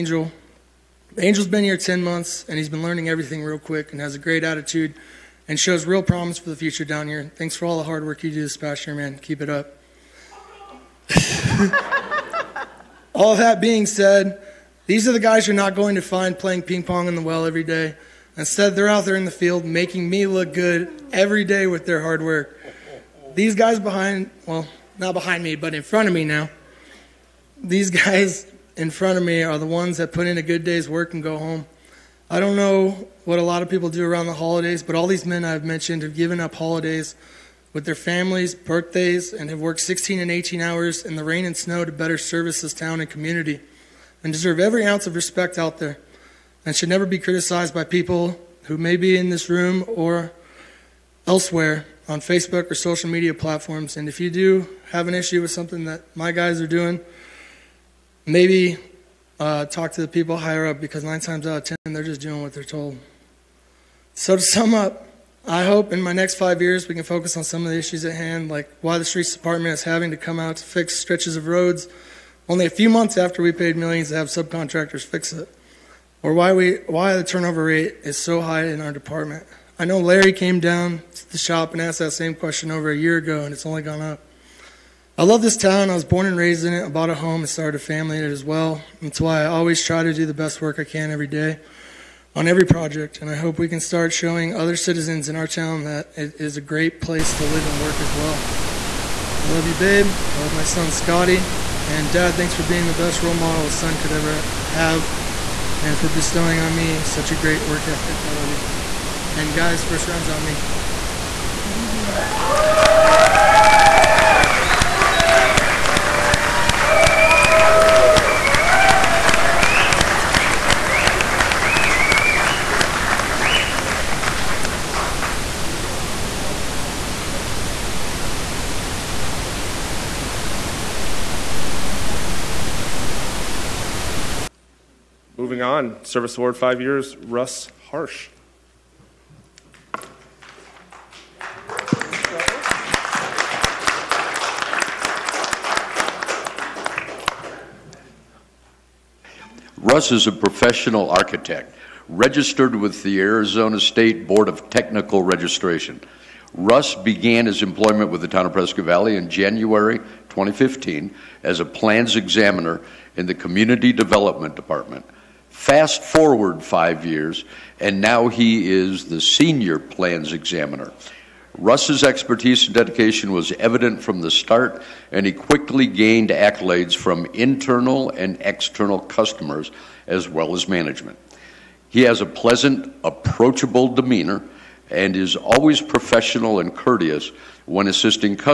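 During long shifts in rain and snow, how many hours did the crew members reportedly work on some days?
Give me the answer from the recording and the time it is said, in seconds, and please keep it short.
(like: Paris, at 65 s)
16 and 18, at 39 s.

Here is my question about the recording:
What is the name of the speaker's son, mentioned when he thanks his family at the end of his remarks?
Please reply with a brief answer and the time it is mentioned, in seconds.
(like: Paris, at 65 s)
Scotty, at 100 s.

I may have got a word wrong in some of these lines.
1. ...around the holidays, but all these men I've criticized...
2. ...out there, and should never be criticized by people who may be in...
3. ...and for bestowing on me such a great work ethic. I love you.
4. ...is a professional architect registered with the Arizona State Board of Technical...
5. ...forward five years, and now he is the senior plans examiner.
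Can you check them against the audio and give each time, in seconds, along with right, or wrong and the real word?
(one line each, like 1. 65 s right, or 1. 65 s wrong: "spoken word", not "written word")
1. 34 s wrong: "mentioned", not "criticized"
2. 45 s right
3. 105 s right
4. 150 s right
5. 166 s right.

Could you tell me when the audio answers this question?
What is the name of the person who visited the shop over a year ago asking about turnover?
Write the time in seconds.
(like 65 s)
79 s.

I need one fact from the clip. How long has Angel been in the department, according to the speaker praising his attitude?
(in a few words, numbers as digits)
10 months.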